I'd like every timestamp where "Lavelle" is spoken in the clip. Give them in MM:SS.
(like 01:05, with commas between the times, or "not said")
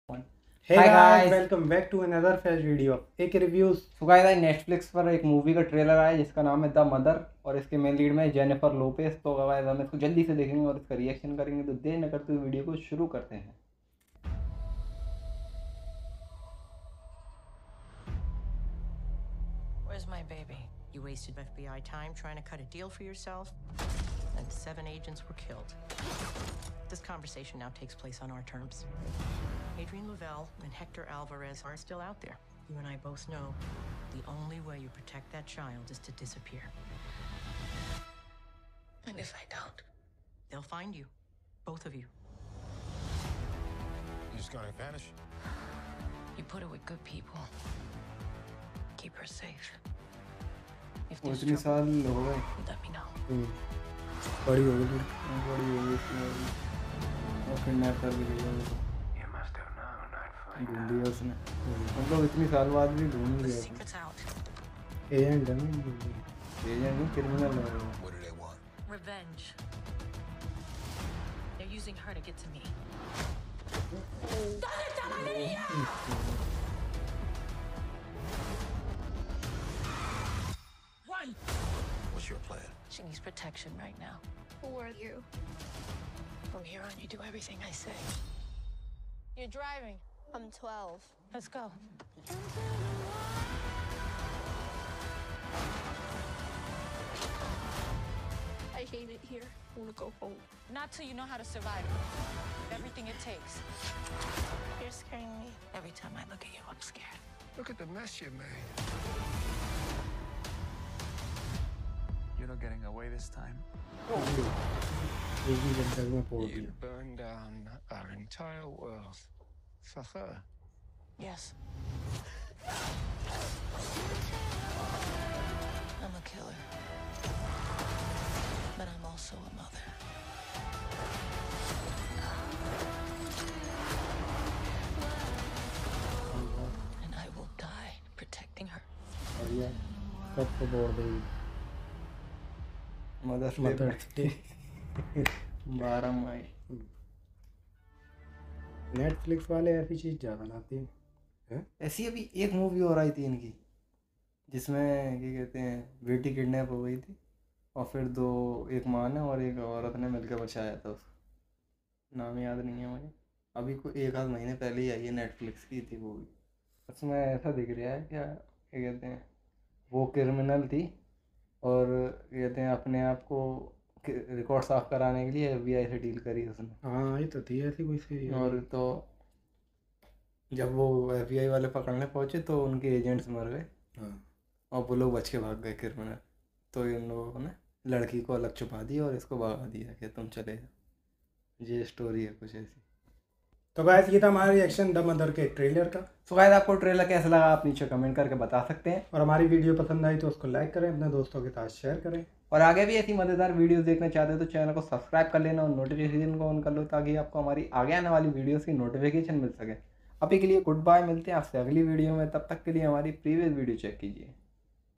00:30.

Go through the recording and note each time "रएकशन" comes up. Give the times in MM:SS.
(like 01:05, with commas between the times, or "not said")
00:11, 03:14.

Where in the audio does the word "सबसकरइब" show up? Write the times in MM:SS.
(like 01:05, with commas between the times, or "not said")
03:24.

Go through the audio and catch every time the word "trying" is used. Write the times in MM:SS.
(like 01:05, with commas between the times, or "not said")
00:22.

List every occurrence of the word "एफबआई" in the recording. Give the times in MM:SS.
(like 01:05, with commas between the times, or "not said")
02:55, 03:01.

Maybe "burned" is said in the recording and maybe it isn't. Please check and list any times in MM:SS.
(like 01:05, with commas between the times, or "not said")
01:56.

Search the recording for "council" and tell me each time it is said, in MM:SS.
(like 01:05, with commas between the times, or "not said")
not said.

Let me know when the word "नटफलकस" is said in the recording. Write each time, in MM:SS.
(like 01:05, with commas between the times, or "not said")
00:04, 02:28, 02:45.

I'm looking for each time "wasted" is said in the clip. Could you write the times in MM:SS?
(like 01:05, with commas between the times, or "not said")
00:21.